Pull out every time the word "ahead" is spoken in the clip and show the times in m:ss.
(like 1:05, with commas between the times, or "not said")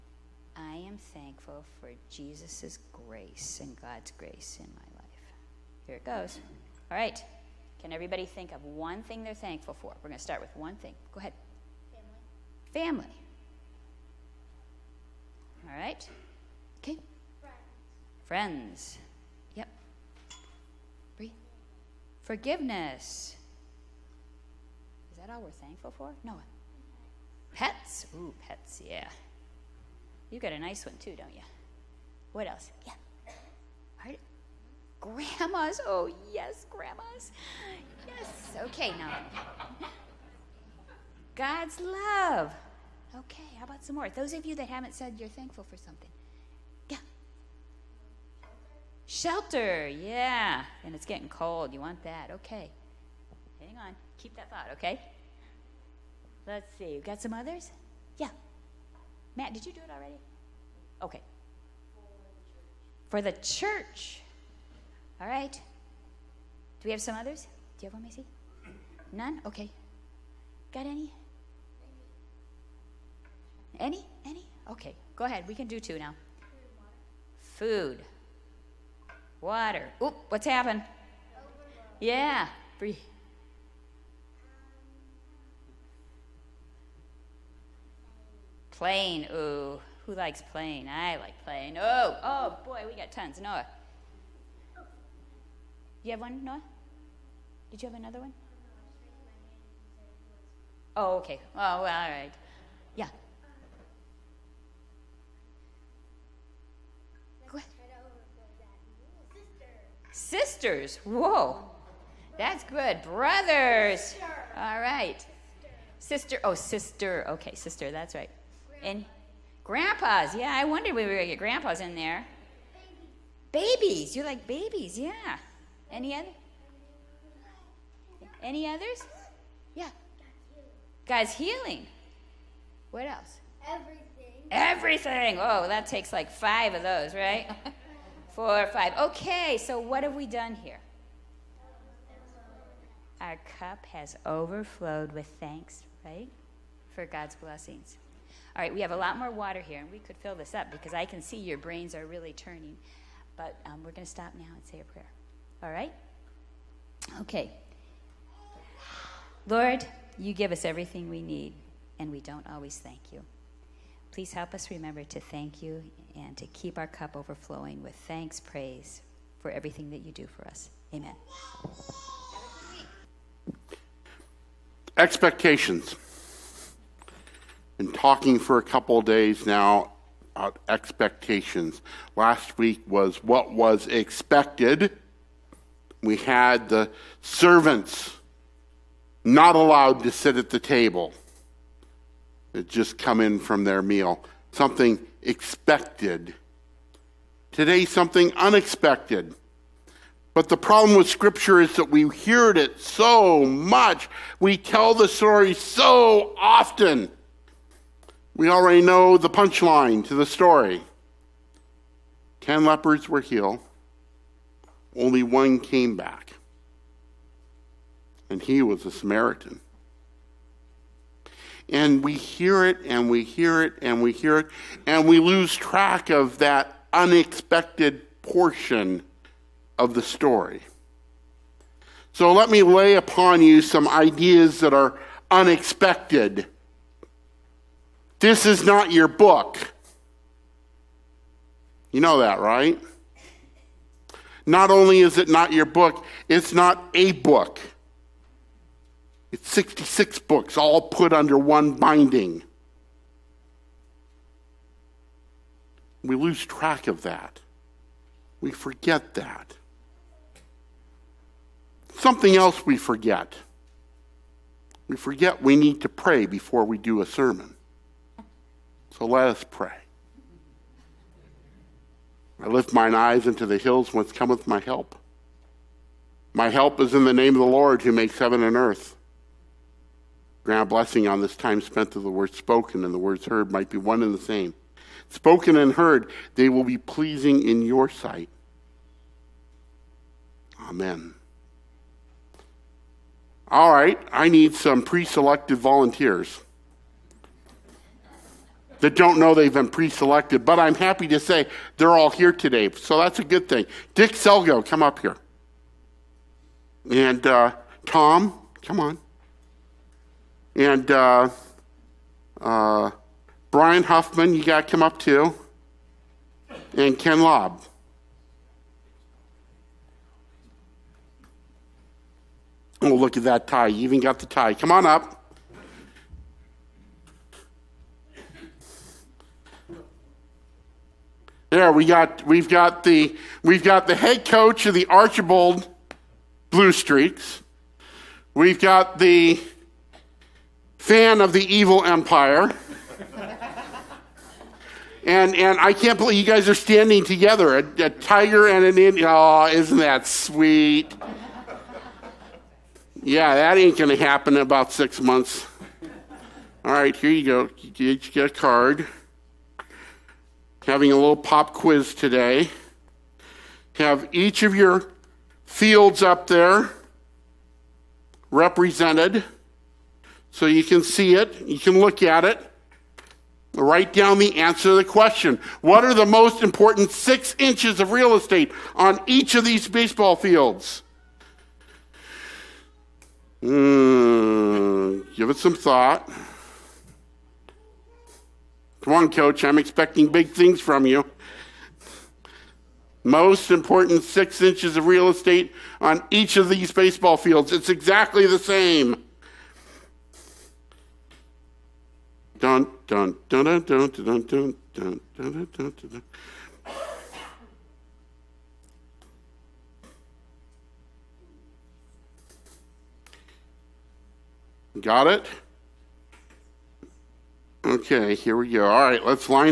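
0:11, 1:15.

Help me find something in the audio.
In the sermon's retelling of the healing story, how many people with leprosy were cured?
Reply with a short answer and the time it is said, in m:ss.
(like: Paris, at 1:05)
10, at 3:32.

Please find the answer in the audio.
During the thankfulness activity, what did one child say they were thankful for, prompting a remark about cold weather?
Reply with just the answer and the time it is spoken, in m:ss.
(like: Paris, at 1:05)
Shelter, at 0:49.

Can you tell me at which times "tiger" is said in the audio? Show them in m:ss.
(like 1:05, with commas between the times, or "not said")
5:47.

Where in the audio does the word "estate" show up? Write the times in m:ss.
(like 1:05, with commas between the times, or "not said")
6:18, 6:35.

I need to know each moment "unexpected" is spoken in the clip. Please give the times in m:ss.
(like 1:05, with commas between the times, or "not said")
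3:18, 3:46, 3:55.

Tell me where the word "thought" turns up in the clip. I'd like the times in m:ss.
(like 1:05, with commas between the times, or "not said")
0:54, 6:25.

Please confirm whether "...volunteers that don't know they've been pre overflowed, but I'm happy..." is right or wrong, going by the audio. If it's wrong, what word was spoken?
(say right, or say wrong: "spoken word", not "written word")
wrong: "selected", not "overflowed".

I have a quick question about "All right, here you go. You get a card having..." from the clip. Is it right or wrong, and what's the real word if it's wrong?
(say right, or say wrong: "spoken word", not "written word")
right.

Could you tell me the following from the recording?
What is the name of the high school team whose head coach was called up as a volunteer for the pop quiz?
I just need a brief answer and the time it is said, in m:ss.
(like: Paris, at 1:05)
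Archbold Blue Streaks, at 5:34.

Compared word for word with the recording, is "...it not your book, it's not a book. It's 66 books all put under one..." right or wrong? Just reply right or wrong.
right.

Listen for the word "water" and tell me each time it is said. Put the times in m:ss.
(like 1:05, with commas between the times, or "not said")
1:19, 2:29.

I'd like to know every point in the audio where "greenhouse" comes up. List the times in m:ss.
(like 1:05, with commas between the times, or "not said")
not said.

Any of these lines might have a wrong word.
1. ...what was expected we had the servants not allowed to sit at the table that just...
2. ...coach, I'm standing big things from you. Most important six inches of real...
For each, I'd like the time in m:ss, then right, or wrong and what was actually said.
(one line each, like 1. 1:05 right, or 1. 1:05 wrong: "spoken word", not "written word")
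1. 3:03 right
2. 6:29 wrong: "expecting", not "standing".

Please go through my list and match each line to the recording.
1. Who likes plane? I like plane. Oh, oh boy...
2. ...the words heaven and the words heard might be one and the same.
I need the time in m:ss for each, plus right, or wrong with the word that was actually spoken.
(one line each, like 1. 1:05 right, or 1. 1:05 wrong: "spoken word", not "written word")
1. 1:30 right
2. 4:42 wrong: "spoken", not "heaven".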